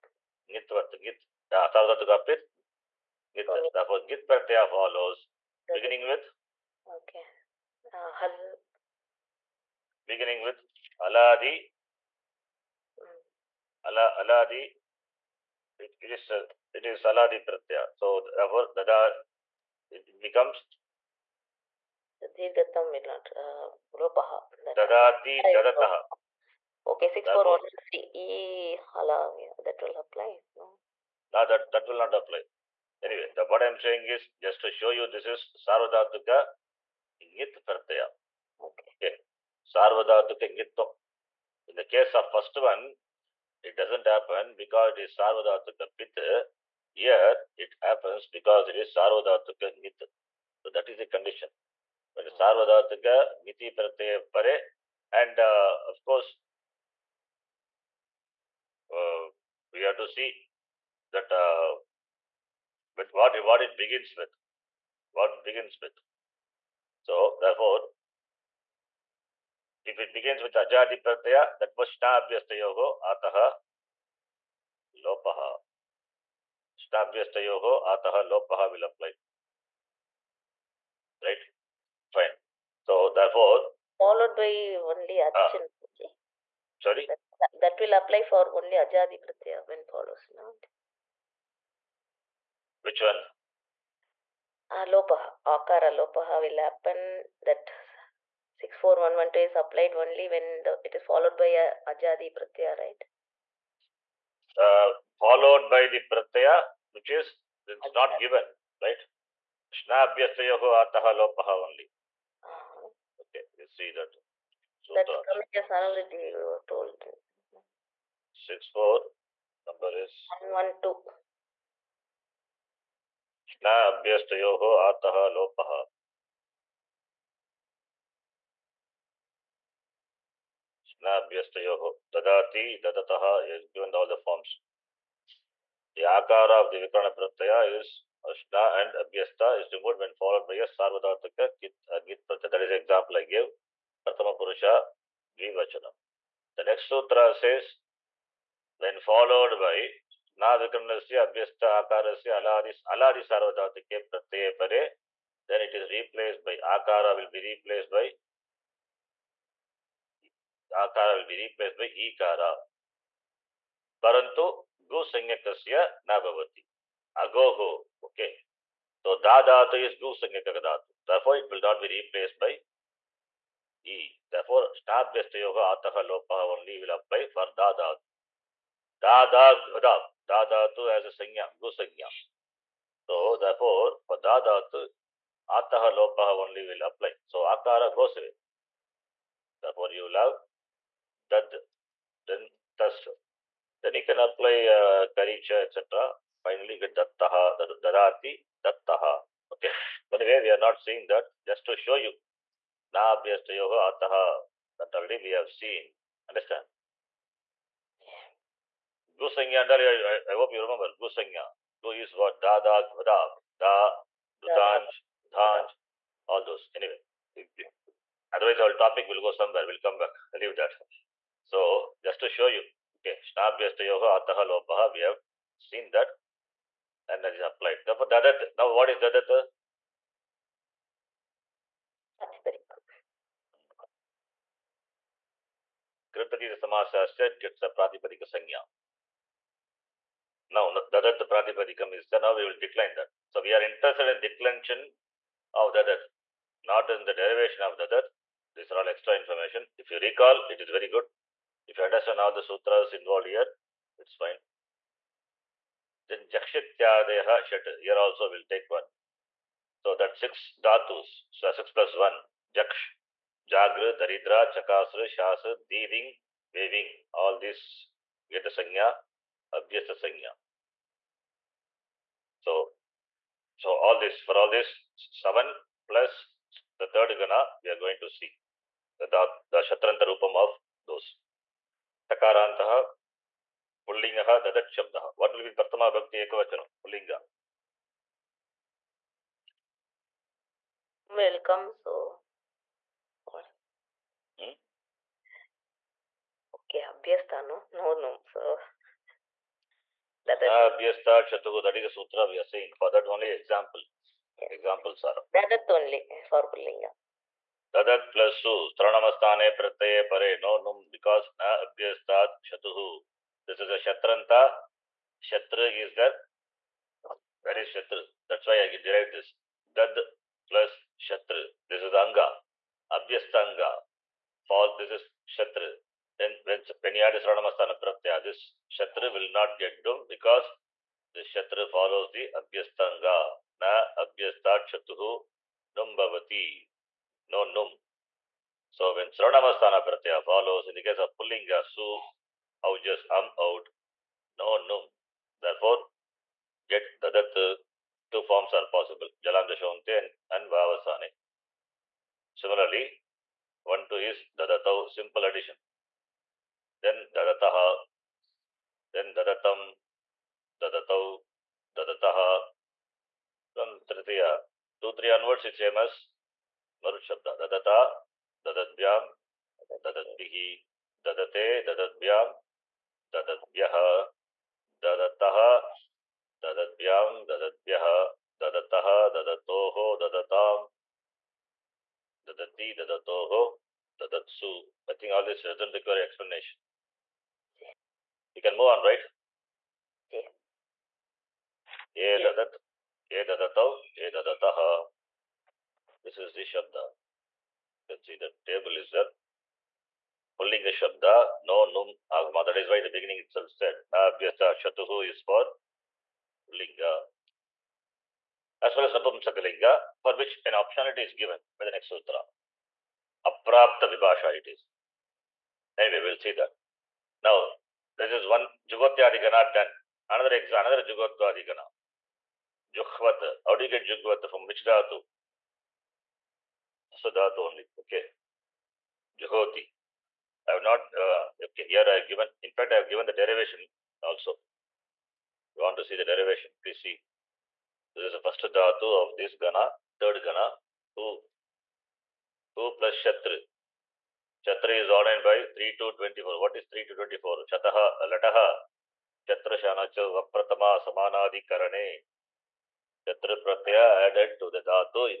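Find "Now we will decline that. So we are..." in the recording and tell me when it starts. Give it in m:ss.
4:02.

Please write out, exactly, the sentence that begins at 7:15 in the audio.
You want to see the derivation, please see.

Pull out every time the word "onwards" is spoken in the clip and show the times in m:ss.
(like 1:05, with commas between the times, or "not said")
6:05.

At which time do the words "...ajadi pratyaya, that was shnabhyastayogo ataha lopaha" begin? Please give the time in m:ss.
1:10.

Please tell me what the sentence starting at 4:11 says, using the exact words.
If you understand all the sutras involved here, it's fine.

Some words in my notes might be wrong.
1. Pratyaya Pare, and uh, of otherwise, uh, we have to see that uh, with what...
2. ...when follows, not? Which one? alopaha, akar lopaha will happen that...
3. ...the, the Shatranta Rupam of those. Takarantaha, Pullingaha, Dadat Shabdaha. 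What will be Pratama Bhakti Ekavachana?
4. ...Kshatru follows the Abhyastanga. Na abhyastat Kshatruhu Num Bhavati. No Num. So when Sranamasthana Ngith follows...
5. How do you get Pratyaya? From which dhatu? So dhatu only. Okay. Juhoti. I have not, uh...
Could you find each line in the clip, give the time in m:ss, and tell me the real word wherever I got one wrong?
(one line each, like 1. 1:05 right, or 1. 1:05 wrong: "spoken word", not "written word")
1. 0:53 wrong: "course", not "otherwise"
2. 1:29 wrong: "alopaha", not "lopaha"
3. 4:38 right
4. 5:31 wrong: "Pratyaya", not "Ngith"
5. 7:03 wrong: "Jugvat", not "Pratyaya".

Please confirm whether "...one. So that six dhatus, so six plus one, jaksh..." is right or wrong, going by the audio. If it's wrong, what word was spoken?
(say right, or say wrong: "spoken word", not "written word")
right.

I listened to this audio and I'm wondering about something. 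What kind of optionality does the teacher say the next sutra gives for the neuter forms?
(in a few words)
Aprapta Vibhasha.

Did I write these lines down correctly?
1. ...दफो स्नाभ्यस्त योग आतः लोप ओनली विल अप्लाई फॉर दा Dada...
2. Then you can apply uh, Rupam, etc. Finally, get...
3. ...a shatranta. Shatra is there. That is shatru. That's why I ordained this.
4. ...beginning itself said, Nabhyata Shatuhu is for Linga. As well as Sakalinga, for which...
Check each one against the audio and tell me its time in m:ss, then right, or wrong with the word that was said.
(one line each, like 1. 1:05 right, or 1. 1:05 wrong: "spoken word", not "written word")
1. 2:54 right
2. 3:13 wrong: "Karicha", not "Rupam"
3. 5:13 wrong: "derived", not "ordained"
4. 6:42 right.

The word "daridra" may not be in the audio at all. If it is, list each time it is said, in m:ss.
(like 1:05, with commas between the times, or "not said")
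4:23.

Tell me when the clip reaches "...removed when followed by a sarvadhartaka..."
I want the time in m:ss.
2:19.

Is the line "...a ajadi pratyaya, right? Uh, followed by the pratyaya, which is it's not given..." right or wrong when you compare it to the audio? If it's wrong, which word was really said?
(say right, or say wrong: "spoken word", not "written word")
right.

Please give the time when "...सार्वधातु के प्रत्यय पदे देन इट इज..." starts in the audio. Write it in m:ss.
2:33.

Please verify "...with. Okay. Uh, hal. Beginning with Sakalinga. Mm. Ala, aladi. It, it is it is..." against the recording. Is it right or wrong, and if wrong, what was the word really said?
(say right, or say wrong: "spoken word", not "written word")
wrong: "Aladi", not "Sakalinga".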